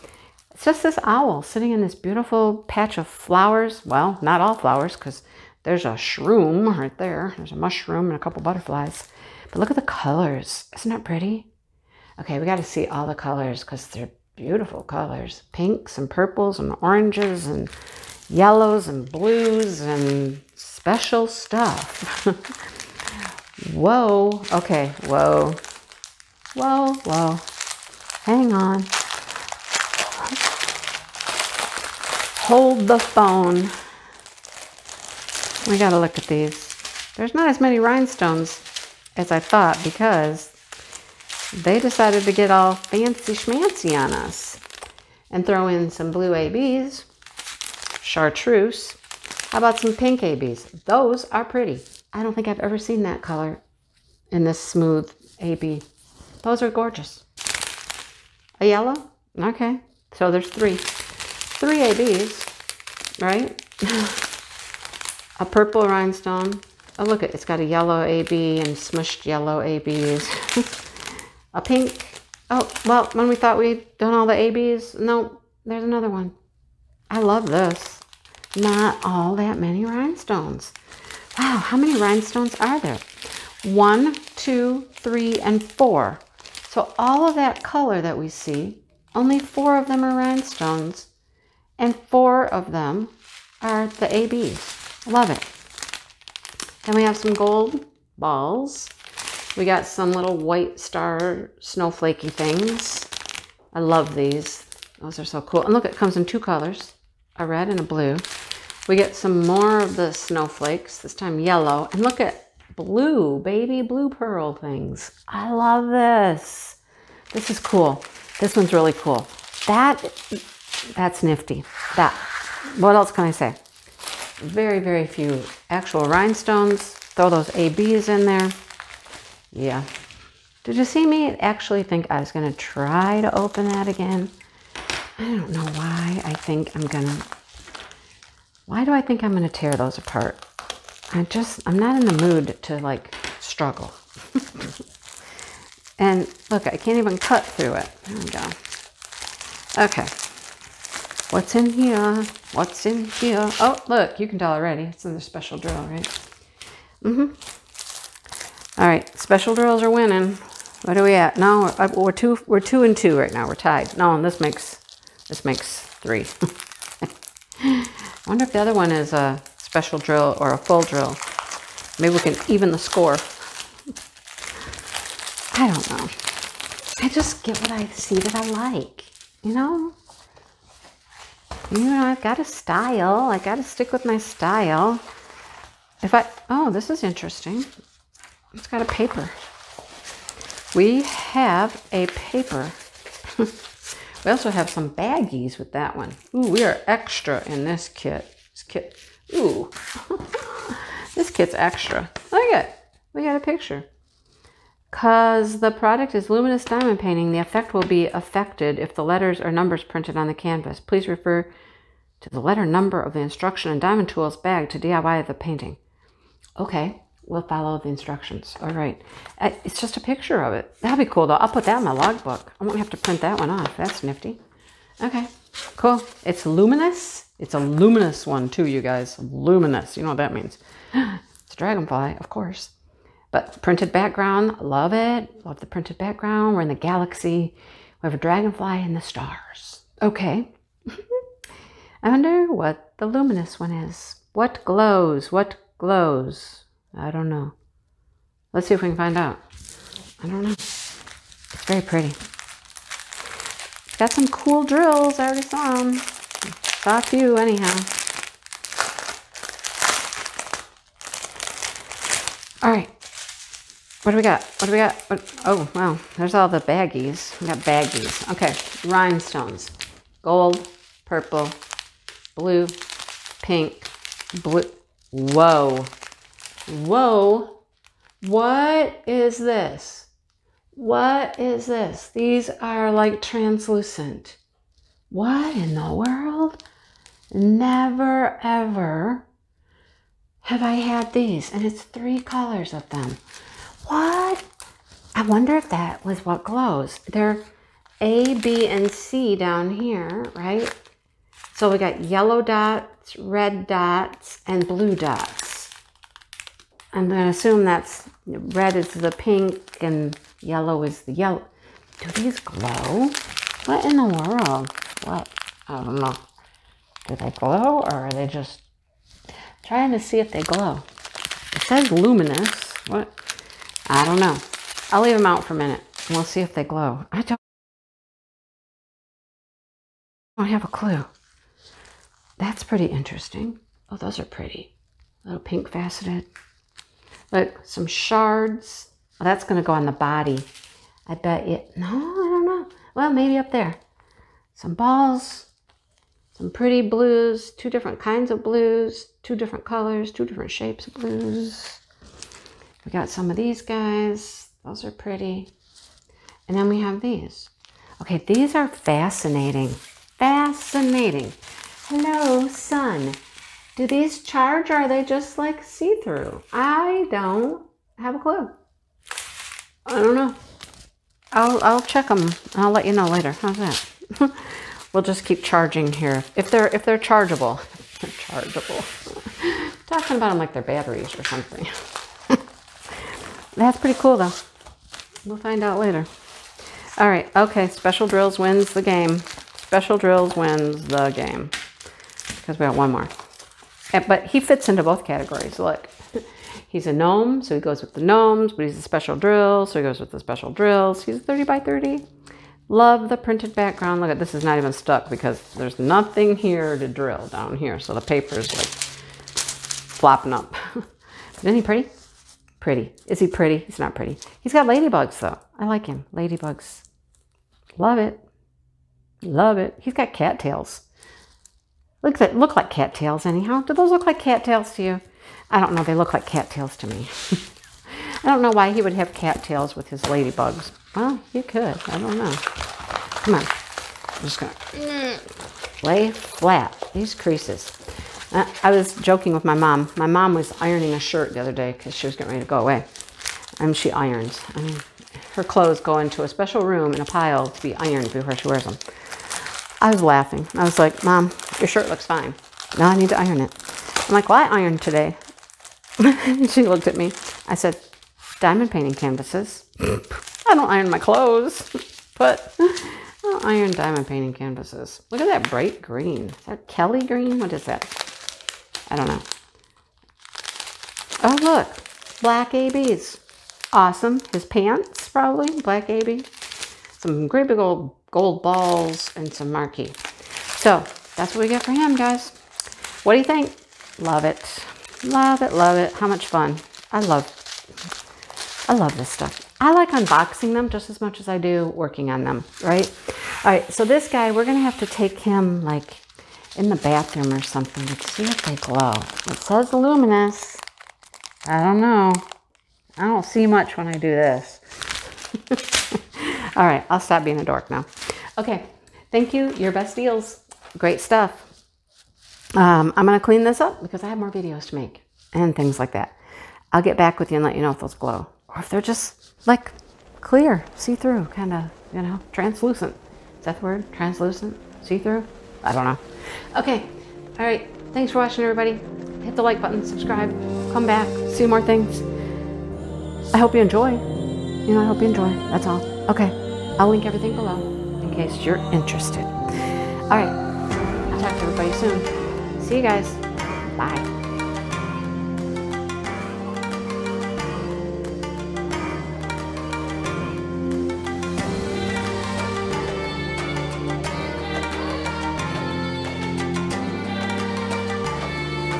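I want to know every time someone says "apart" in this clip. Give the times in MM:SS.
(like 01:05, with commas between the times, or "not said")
02:19.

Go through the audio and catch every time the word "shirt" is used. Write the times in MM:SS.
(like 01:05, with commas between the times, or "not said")
07:20, 07:31.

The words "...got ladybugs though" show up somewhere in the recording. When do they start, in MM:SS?
06:54.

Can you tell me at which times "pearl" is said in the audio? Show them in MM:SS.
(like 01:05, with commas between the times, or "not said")
01:54.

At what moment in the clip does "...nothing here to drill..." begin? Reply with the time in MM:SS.
06:45.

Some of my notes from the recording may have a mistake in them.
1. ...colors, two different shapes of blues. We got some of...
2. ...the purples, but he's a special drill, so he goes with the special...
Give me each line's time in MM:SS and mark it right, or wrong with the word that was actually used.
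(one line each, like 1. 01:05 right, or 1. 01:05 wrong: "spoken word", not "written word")
1. 05:49 right
2. 06:37 wrong: "gnomes", not "purples".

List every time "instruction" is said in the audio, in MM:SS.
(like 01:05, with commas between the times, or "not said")
03:33, 03:37.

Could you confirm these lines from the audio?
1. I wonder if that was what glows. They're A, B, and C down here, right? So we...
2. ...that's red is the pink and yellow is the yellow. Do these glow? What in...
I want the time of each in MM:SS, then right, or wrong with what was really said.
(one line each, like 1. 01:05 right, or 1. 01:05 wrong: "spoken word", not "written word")
1. 04:55 right
2. 05:07 right.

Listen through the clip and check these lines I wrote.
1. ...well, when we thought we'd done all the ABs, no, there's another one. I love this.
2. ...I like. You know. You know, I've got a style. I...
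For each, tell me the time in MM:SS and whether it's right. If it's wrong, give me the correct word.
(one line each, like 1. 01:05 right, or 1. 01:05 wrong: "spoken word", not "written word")
1. 01:12 right
2. 02:58 right.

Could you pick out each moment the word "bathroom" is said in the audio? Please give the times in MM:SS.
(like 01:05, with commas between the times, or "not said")
08:16.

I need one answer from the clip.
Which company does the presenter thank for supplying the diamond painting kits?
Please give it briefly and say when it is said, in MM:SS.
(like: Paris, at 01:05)
Urbestdeals, at 08:29.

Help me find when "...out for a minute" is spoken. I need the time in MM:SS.
05:25.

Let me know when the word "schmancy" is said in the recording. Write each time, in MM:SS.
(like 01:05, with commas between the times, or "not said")
00:43.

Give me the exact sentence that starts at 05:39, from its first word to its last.
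Well, oh, that's going to go on the body.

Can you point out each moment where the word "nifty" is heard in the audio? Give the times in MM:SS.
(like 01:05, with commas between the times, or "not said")
02:01, 03:44.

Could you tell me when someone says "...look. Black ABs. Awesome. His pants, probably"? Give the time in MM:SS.
07:51.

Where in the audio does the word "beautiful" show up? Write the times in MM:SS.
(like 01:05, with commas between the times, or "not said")
00:01, 00:14.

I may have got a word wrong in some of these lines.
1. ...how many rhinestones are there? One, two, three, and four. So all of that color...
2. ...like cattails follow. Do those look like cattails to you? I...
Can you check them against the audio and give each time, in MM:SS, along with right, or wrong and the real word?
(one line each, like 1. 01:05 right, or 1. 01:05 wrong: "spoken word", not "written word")
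1. 01:21 right
2. 07:02 wrong: "anyhow", not "follow".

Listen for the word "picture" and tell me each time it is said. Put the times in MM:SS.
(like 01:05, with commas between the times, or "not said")
03:23, 03:40.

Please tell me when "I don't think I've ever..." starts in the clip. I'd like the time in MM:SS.
00:52.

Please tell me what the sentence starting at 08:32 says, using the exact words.
Um, I'm going to clean this up because I have more videos to make and things like that.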